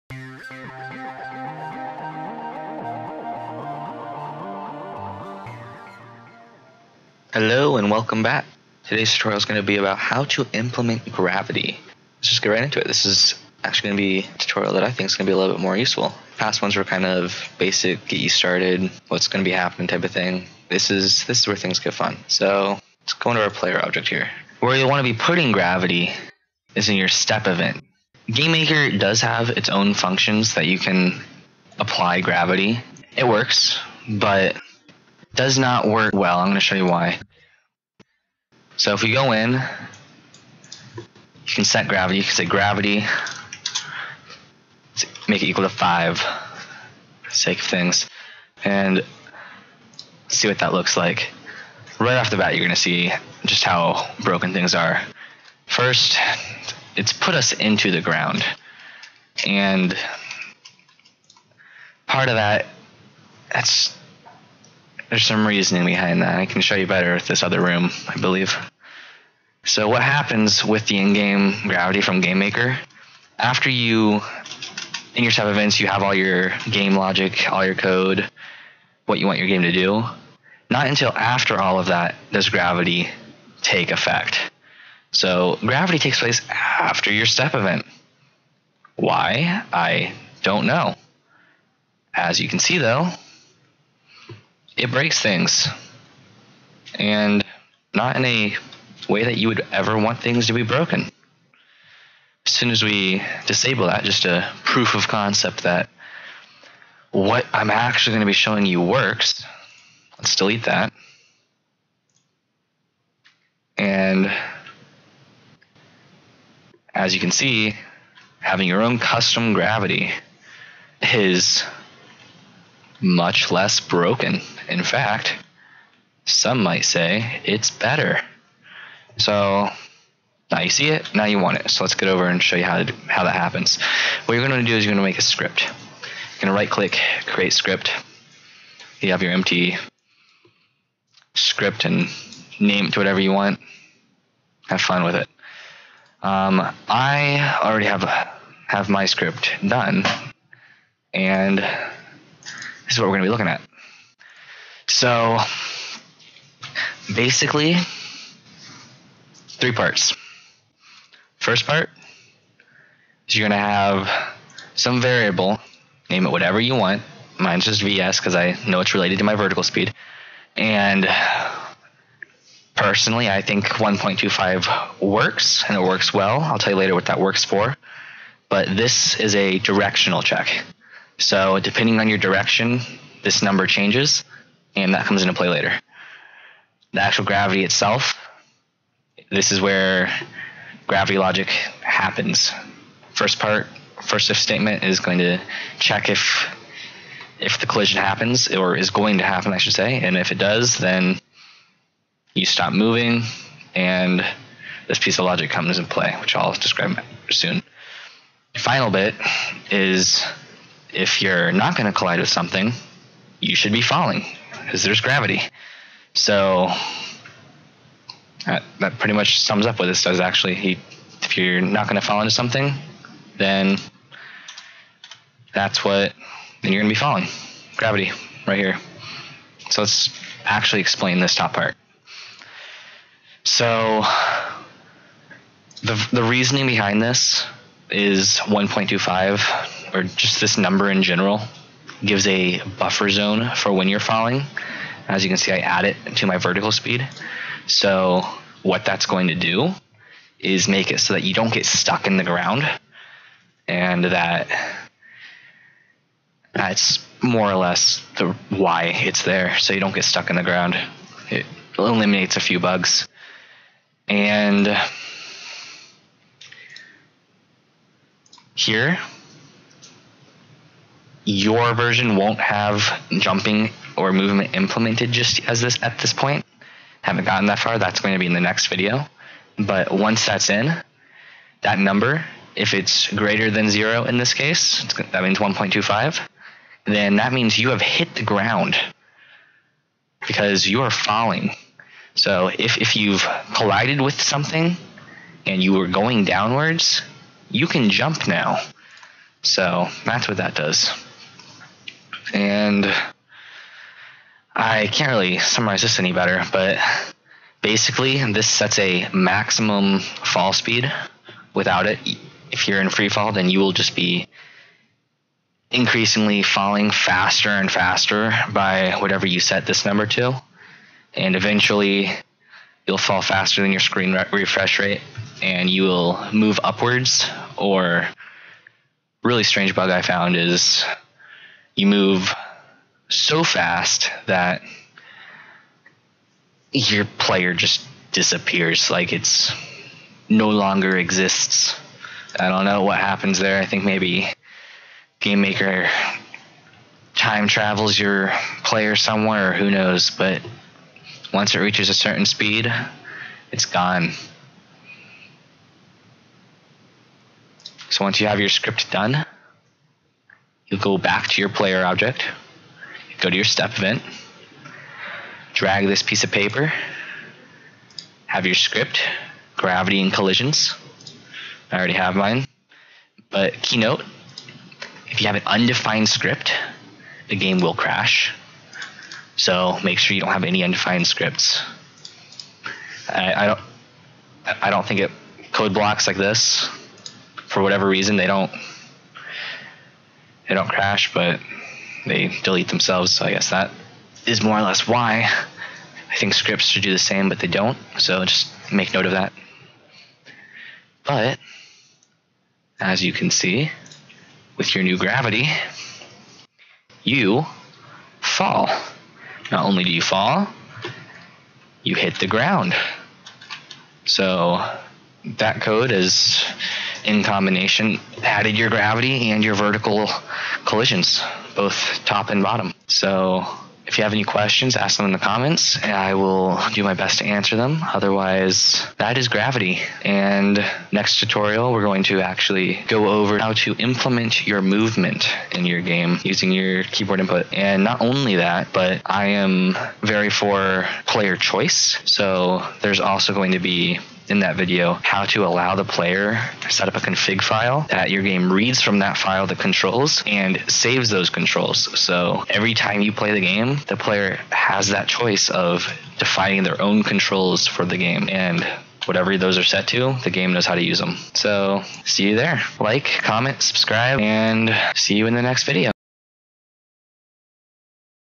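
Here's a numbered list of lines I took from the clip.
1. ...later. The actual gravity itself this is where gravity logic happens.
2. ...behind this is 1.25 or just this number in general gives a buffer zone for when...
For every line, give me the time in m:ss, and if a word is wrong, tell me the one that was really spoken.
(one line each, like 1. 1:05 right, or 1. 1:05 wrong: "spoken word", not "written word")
1. 3:05 right
2. 3:56 right.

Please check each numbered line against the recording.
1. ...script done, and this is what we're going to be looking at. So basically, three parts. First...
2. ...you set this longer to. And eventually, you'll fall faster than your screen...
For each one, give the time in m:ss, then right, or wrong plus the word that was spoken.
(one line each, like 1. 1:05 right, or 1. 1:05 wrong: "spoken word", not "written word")
1. 2:29 right
2. 5:19 wrong: "number", not "longer".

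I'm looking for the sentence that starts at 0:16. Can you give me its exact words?
Past ones were kind of basic, get you started, what's going to be happening type of thing.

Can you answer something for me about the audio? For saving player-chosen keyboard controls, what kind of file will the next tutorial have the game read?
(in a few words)
config file.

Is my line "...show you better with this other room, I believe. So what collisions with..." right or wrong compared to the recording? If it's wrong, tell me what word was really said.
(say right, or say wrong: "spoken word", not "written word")
wrong: "happens", not "collisions".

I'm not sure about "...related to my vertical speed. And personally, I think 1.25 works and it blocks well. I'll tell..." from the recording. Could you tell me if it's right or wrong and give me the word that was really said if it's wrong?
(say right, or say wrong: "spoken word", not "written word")
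wrong: "works", not "blocks".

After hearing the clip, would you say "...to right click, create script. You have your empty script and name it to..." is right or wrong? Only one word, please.
right.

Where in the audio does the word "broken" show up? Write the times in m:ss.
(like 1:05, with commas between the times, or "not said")
0:54, 1:40, 2:03.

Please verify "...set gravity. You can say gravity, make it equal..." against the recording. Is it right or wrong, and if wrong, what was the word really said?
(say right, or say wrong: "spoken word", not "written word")
right.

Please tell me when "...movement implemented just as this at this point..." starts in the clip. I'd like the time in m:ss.
4:34.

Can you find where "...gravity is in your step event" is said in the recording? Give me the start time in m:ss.
0:25.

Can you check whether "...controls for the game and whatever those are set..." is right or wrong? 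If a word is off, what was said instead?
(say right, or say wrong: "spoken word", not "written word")
right.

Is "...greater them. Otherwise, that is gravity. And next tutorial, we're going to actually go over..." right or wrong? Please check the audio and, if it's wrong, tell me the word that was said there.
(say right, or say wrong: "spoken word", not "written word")
wrong: "answer", not "greater".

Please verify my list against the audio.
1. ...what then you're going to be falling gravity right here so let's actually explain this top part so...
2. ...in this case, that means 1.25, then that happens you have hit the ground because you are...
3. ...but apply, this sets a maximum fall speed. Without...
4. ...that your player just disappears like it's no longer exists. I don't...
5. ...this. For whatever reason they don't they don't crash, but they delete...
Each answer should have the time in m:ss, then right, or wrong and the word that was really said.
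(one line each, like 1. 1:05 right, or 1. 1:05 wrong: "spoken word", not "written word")
1. 3:45 right
2. 4:44 wrong: "means", not "happens"
3. 5:06 wrong: "basically", not "apply"
4. 5:34 right
5. 6:26 right.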